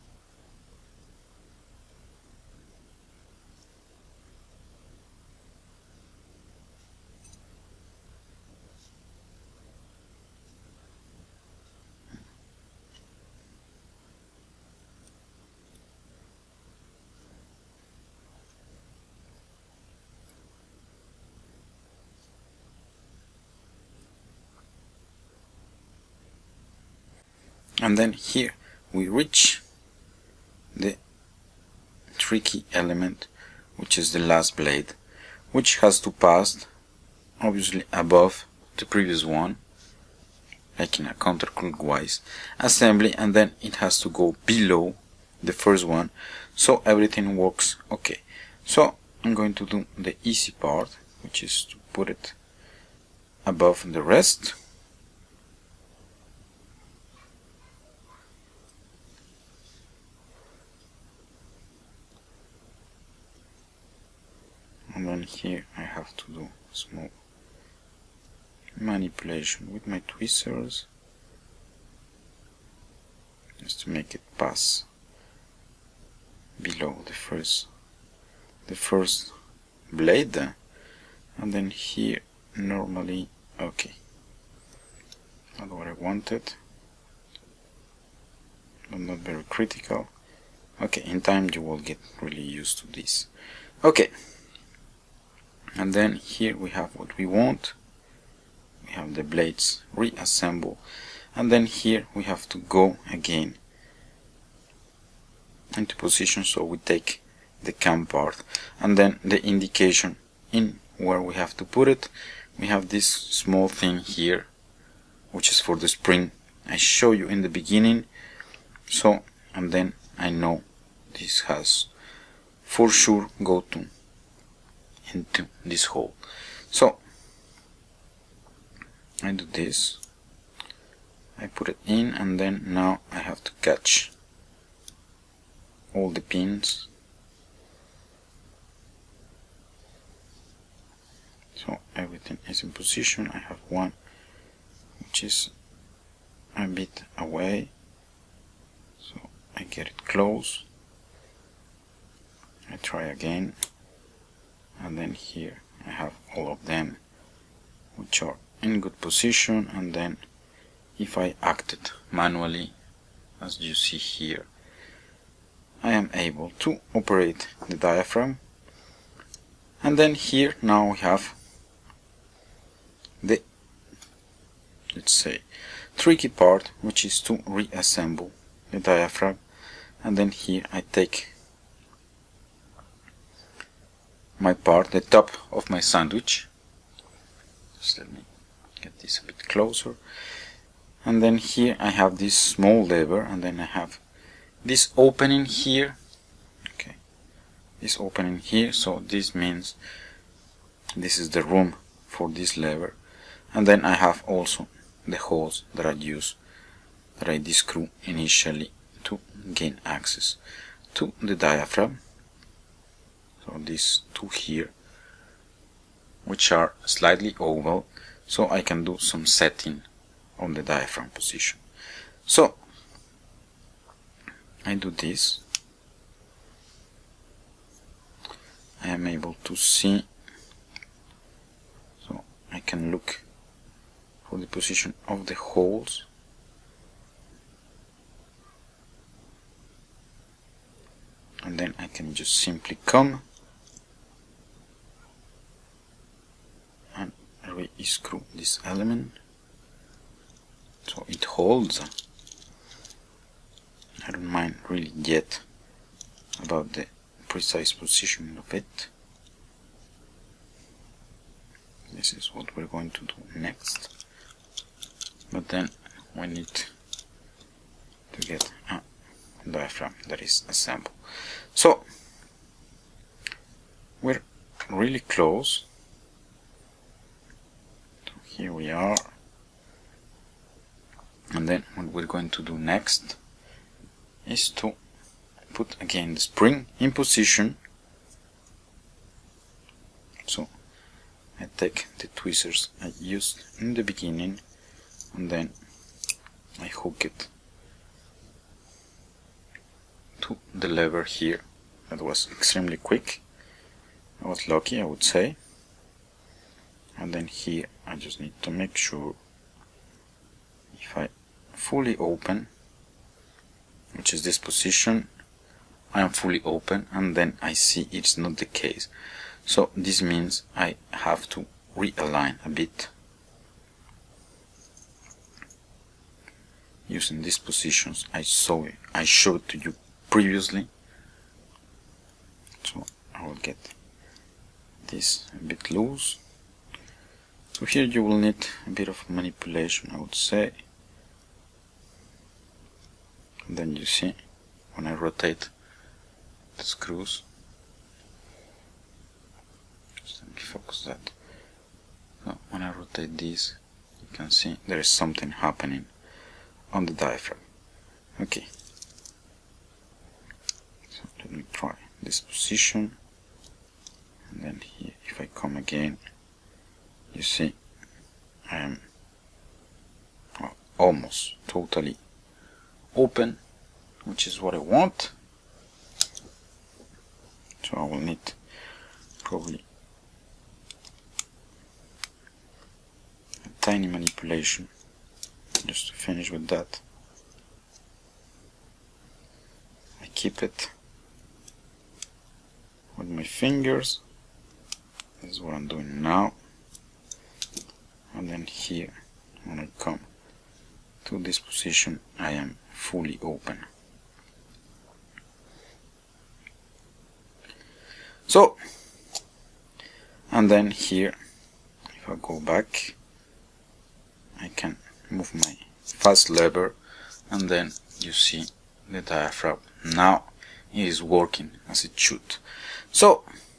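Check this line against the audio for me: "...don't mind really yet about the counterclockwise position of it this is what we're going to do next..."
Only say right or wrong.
wrong.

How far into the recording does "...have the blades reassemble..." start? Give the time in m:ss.
1:38.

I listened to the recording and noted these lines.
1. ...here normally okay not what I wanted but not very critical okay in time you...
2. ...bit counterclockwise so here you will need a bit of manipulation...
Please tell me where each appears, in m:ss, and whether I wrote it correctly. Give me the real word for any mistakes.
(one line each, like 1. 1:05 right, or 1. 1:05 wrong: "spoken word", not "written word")
1. 1:21 right
2. 5:35 wrong: "loose", not "counterclockwise".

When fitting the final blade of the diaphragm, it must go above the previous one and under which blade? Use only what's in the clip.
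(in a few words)
The first one.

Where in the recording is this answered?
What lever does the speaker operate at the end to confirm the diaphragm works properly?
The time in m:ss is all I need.
6:55.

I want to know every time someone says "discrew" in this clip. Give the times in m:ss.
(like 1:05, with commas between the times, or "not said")
3:27.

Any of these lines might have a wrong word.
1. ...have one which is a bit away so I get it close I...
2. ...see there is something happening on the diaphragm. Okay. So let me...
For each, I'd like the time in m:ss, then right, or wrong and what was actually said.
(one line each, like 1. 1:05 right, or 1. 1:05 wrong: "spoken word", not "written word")
1. 2:23 right
2. 5:54 right.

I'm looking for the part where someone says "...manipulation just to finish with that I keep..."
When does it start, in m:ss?
6:23.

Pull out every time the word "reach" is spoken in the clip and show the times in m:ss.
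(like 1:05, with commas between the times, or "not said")
0:29.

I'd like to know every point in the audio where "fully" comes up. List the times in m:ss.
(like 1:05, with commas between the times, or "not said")
5:11, 5:16, 6:42.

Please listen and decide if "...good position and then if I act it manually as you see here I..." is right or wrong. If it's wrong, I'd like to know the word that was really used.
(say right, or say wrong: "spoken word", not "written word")
right.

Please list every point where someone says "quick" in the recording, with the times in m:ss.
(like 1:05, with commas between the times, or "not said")
5:02.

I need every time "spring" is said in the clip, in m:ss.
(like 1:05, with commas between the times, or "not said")
1:55, 4:46.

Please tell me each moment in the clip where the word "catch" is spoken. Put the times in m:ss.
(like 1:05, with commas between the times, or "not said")
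2:13.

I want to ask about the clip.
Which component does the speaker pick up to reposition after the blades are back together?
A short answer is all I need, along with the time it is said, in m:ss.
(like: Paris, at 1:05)
The cam part, at 1:47.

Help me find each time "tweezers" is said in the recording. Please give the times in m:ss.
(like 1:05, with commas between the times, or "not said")
1:10, 4:52.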